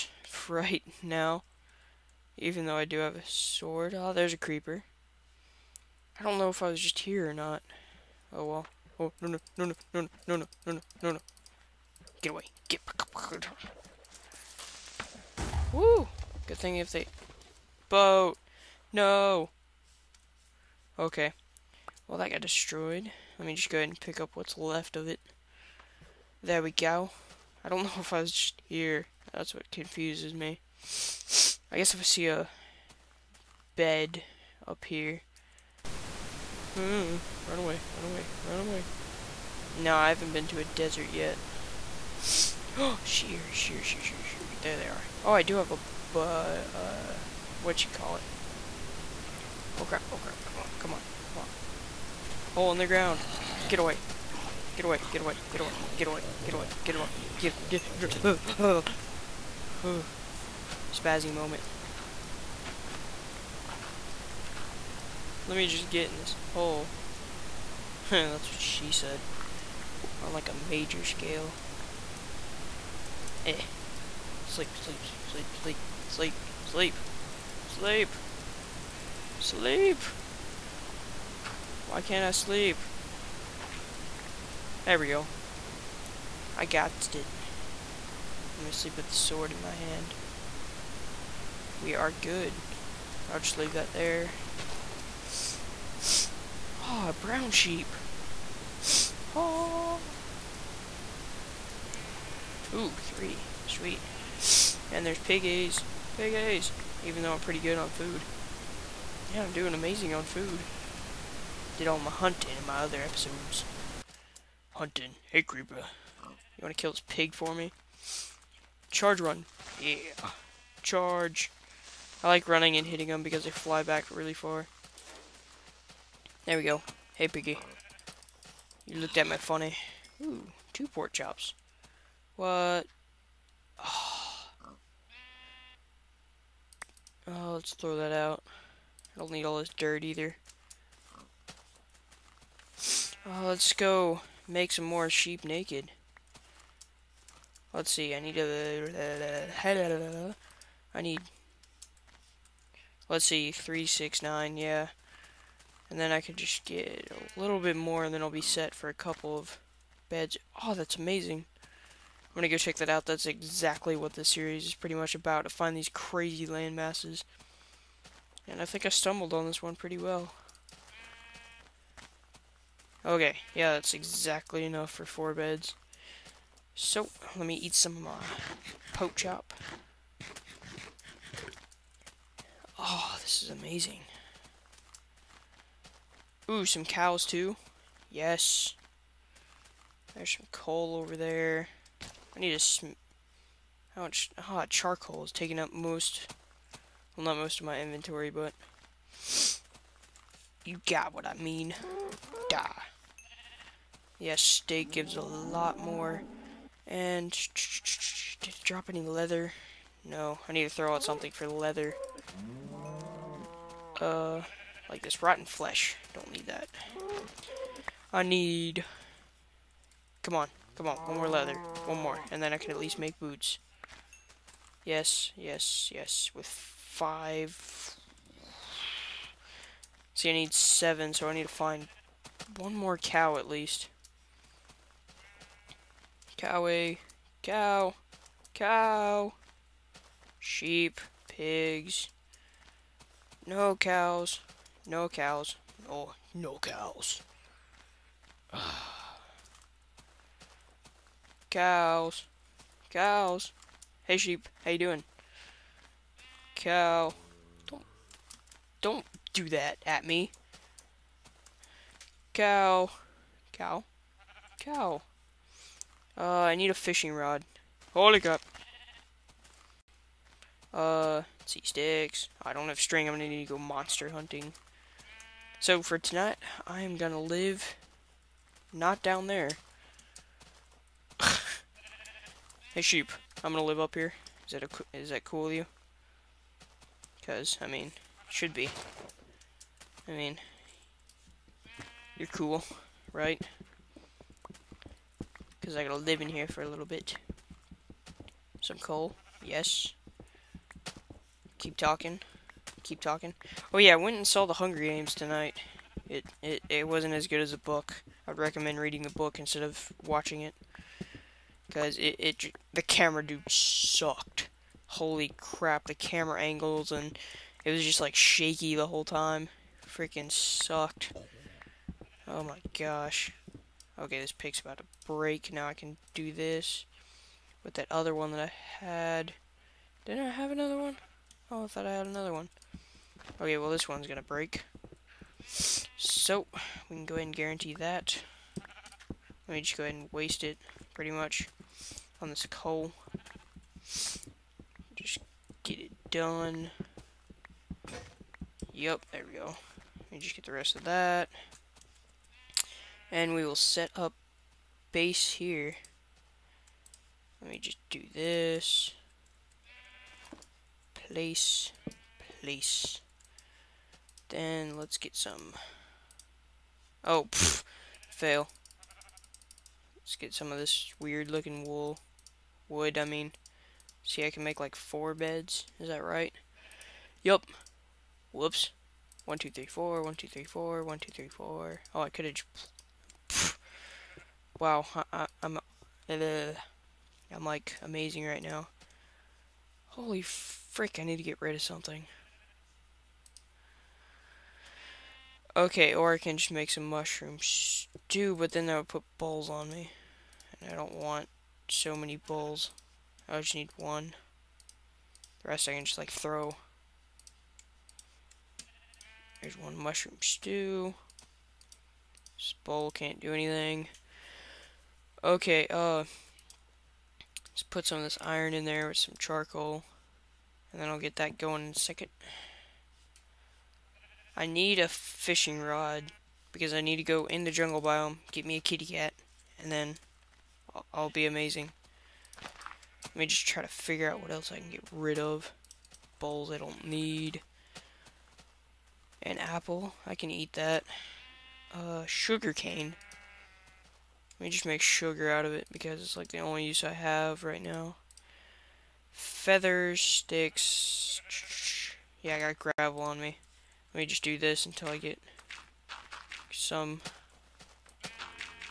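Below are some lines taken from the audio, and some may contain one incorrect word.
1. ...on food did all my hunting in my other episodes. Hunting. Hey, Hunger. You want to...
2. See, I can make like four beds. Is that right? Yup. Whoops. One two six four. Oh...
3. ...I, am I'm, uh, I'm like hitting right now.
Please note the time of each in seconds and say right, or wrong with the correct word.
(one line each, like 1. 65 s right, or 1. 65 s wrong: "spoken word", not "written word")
1. 110 s wrong: "Creeper", not "Hunger"
2. 374 s wrong: "three", not "six"
3. 385 s wrong: "amazing", not "hitting".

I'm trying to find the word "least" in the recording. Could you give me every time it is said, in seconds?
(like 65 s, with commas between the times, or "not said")
222 s, 233 s.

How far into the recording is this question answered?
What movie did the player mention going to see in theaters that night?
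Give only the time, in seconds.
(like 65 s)
304 s.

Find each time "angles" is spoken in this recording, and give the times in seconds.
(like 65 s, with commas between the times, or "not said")
316 s.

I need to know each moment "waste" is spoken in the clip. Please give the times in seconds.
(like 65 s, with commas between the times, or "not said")
340 s.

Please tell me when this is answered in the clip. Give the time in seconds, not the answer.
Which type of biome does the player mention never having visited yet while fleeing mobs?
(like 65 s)
40 s.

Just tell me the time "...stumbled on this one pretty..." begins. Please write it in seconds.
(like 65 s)
168 s.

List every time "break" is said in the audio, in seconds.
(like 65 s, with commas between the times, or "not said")
325 s, 334 s.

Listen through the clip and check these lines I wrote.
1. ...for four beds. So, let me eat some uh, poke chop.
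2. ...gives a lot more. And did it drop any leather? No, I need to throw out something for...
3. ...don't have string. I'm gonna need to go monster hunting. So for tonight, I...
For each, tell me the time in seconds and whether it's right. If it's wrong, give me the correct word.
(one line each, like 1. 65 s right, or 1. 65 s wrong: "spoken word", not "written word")
1. 174 s right
2. 204 s right
3. 272 s right.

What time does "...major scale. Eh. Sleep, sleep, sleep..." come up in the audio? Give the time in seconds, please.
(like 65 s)
70 s.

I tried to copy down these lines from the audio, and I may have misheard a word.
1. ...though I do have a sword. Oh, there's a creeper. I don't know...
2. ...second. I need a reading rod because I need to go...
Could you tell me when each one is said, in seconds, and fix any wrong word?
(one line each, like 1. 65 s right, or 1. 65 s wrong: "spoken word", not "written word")
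1. 2 s right
2. 421 s wrong: "fishing", not "reading".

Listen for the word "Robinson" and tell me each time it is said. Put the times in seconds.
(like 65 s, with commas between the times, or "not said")
not said.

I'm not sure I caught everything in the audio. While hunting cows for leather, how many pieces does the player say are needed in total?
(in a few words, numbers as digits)
7.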